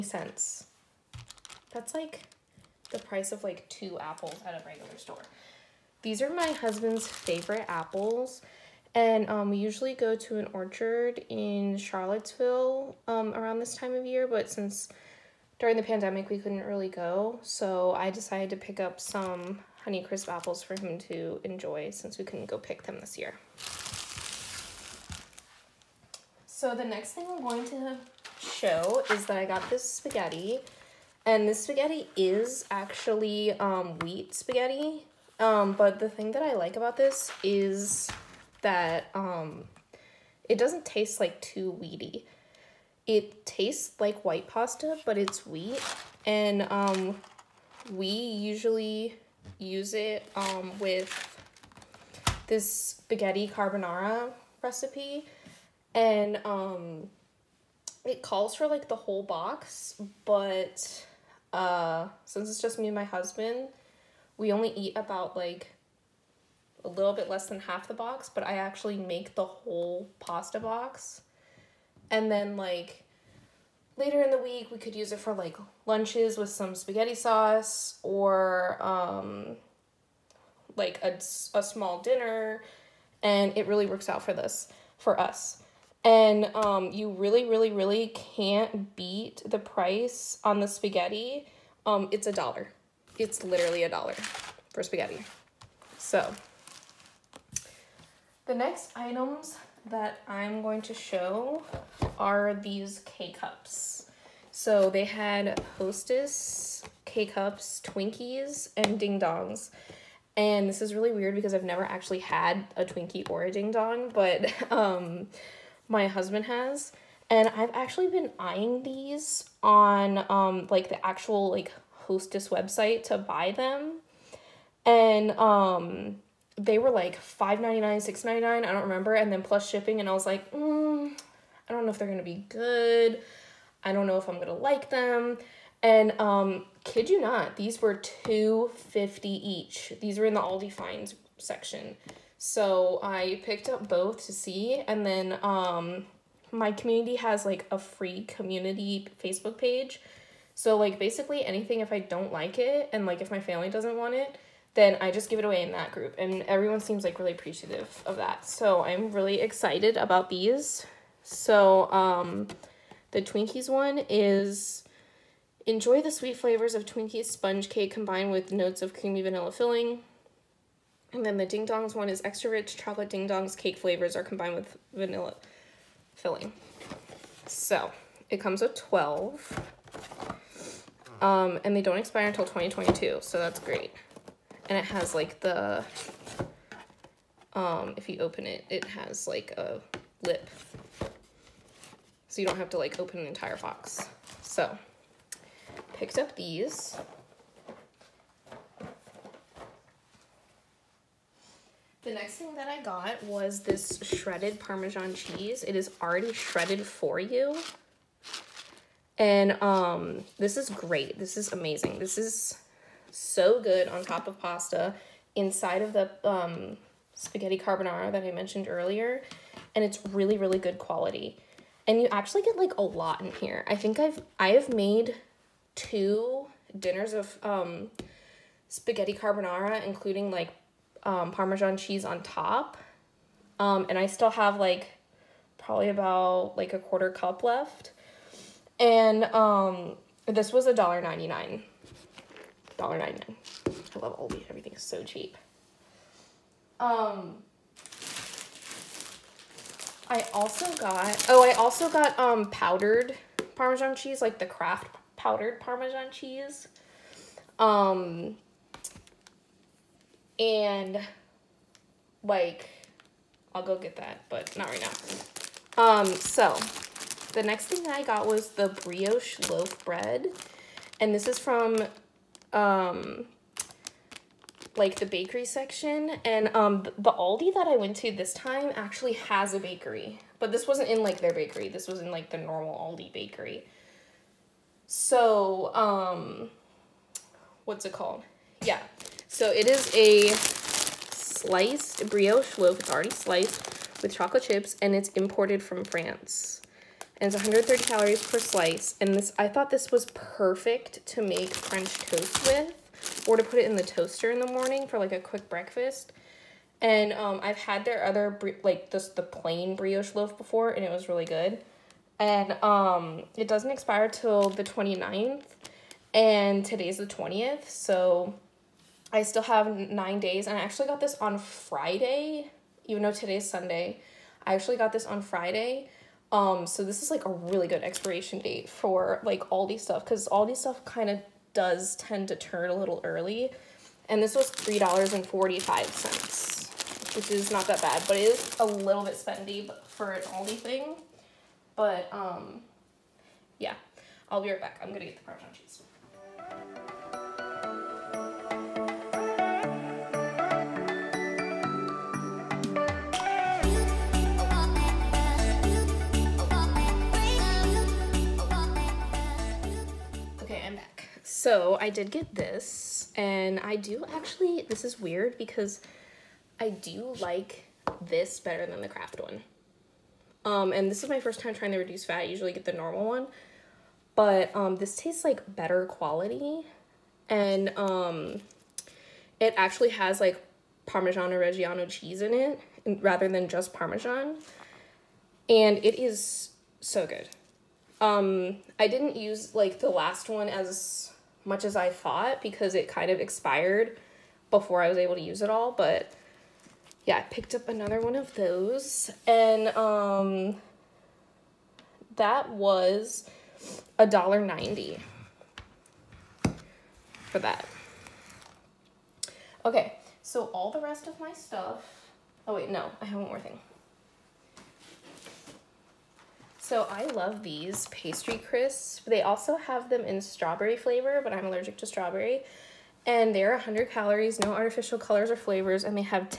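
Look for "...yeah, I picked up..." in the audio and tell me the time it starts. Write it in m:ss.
6:37.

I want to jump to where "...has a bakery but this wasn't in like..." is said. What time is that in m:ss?
4:39.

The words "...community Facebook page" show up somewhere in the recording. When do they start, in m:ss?
2:28.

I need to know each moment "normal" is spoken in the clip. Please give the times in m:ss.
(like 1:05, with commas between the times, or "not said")
4:42, 6:12.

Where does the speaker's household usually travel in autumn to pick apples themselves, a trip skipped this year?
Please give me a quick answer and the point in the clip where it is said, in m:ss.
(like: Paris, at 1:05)
Charlottesville, at 0:11.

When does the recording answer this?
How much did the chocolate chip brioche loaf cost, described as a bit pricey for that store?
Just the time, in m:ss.
5:34.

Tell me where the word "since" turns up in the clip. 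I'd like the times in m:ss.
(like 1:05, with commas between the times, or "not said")
0:14, 0:21, 1:02.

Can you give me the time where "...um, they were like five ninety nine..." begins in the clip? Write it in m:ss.
2:05.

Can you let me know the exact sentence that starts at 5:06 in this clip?
And um, I've had their other, like just the plain brioche loaf before and it was really good.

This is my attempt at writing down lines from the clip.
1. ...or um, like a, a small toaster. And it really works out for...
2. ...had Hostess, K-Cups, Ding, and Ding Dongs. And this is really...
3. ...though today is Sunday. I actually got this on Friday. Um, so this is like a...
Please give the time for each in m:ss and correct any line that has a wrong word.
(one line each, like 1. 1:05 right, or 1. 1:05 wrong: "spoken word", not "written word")
1. 1:18 wrong: "dinner", not "toaster"
2. 1:45 wrong: "Twinkies", not "Ding"
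3. 5:23 right.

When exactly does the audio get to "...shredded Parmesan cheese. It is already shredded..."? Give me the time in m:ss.
3:24.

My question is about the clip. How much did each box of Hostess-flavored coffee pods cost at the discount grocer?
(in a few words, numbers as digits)
$2.50.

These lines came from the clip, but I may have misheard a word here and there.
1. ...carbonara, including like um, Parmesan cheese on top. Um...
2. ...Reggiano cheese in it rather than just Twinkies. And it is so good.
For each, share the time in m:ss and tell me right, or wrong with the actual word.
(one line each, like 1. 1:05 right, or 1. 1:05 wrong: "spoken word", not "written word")
1. 3:49 right
2. 6:21 wrong: "Parmesan", not "Twinkies".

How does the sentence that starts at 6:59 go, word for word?
They also have them in strawberry flavor, but I'm allergic to strawberry.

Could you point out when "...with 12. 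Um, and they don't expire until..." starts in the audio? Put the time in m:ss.
2:58.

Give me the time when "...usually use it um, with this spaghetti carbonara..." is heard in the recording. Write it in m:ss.
0:48.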